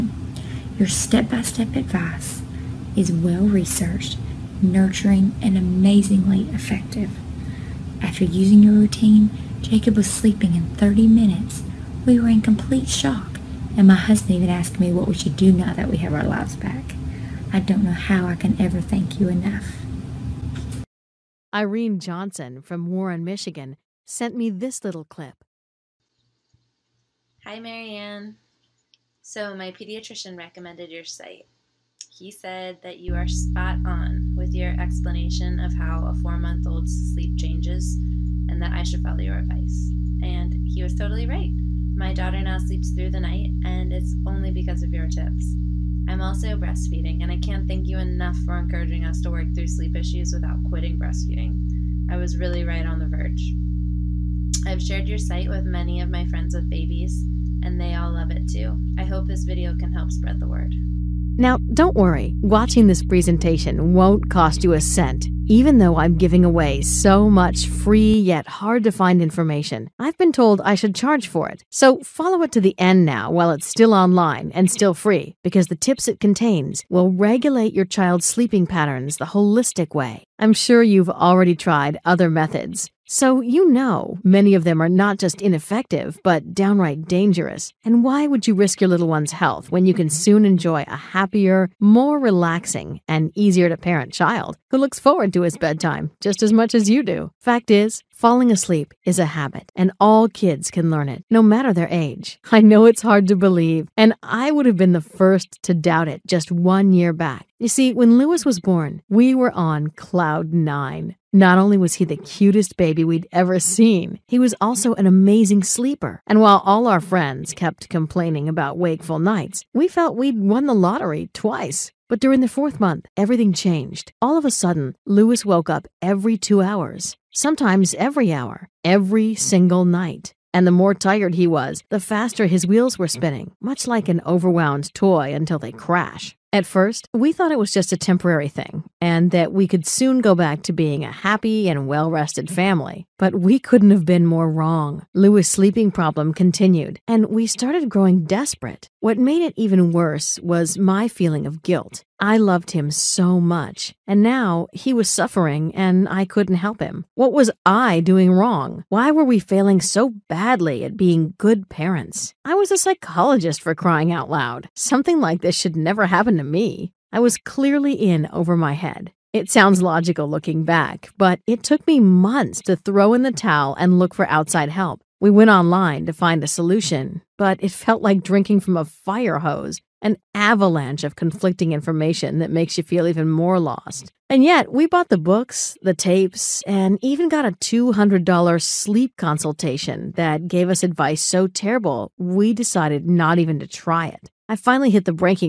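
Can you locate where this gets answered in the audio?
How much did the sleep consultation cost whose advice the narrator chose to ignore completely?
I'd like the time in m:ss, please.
3:07.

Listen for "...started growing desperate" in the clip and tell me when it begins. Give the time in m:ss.
2:27.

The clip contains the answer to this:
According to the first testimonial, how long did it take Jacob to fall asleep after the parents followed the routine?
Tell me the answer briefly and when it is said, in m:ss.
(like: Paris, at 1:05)
30 minutes, at 0:10.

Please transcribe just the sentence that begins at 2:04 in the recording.
All of a sudden, Lewis woke up every two hours, sometimes every hour, every single night.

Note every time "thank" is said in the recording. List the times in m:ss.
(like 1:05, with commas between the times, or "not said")
0:18, 0:47.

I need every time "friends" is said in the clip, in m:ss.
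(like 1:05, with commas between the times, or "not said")
0:56, 1:57.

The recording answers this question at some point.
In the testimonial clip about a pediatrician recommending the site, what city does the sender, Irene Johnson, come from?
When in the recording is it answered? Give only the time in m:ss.
0:22.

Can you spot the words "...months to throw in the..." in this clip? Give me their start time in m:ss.
2:51.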